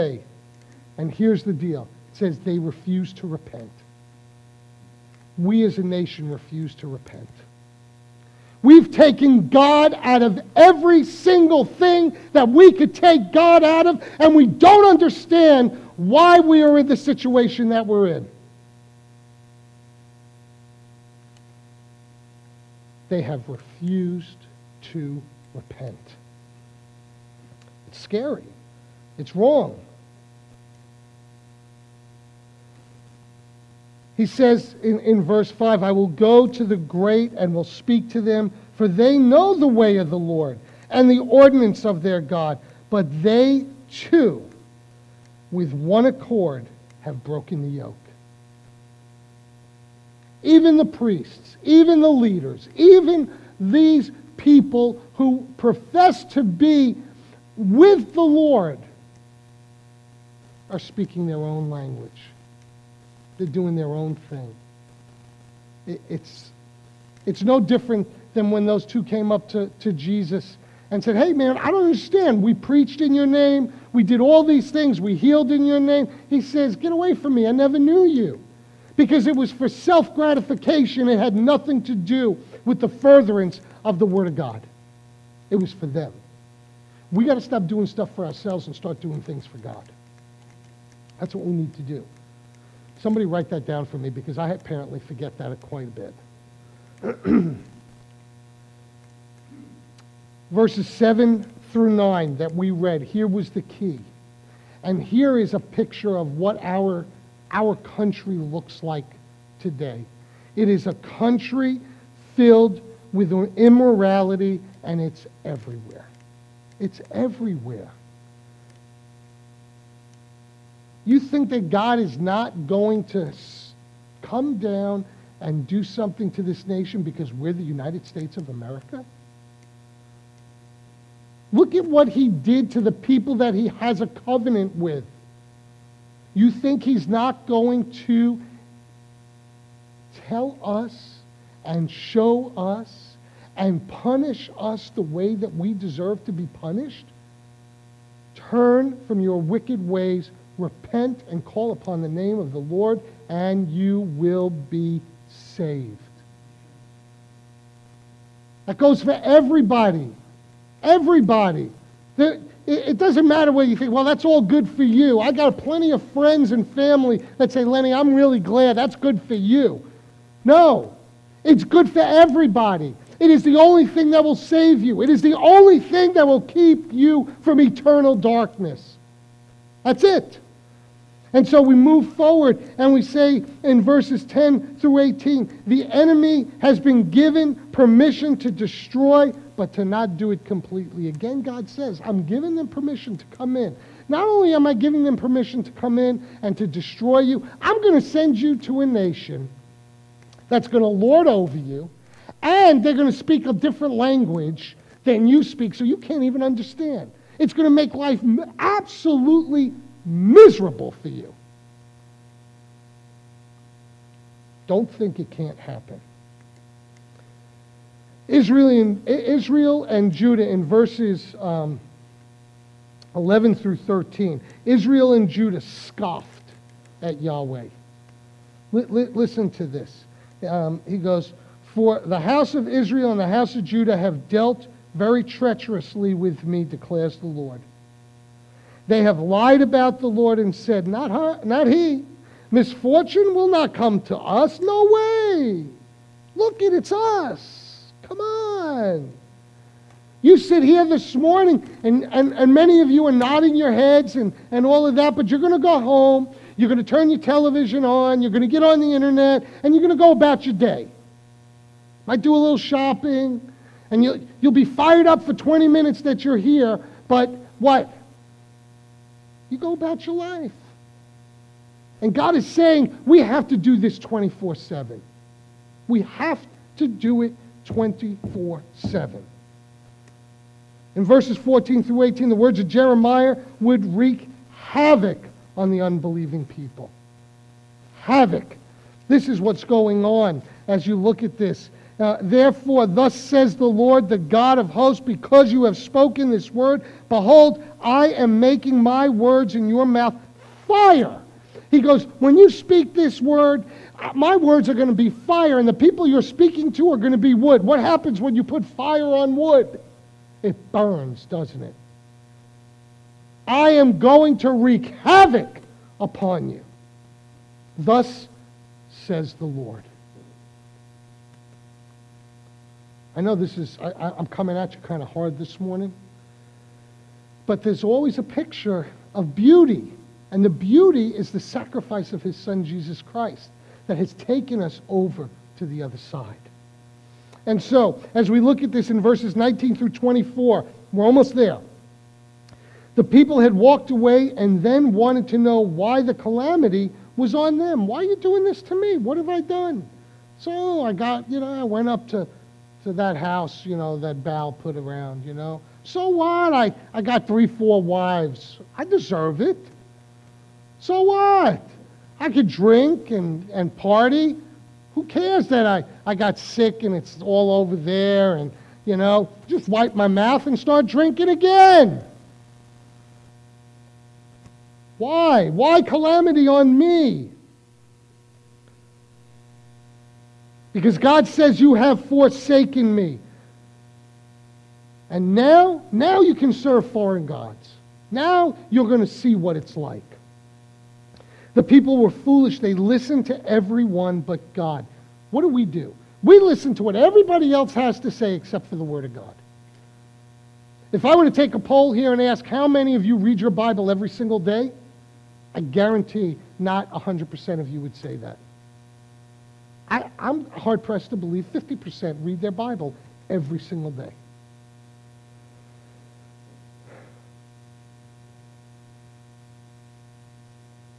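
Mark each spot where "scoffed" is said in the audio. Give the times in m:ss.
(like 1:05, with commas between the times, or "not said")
3:45.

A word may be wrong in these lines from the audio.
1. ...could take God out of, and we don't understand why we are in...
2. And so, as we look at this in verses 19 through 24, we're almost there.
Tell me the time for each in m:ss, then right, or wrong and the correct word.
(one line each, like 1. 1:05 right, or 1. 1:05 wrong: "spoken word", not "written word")
1. 0:12 right
2. 5:37 right.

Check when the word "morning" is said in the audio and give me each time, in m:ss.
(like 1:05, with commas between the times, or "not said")
4:11, 5:25.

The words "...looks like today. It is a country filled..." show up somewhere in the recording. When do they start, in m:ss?
1:48.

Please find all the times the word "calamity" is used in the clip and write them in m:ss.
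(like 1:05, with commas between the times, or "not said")
5:46, 6:15.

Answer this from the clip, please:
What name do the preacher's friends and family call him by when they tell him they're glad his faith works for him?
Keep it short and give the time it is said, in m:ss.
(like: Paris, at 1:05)
Lenny, at 2:47.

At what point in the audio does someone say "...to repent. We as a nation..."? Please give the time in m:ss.
0:03.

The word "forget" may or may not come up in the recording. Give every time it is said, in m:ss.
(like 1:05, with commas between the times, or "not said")
1:34.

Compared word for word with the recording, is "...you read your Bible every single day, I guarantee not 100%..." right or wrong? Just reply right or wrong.
right.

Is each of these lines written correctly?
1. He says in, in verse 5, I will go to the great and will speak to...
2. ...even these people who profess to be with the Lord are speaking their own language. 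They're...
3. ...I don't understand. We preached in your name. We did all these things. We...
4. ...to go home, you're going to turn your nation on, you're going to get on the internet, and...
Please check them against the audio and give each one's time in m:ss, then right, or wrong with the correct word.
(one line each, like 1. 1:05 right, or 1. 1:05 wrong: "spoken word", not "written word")
1. 0:34 right
2. 0:52 right
3. 1:11 right
4. 4:15 wrong: "television", not "nation".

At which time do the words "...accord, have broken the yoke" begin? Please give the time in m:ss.
0:46.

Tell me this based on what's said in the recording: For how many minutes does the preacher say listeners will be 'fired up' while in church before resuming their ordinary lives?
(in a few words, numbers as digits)
20.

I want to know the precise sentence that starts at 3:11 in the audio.
Again, God says, I'm giving them permission to come in.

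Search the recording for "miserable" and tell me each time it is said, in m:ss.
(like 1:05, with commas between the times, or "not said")
3:30.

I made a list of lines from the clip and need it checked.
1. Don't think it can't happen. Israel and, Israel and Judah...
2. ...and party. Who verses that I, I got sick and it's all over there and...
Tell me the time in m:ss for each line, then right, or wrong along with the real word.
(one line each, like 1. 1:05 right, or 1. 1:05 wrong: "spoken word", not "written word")
1. 3:34 right
2. 6:03 wrong: "cares", not "verses".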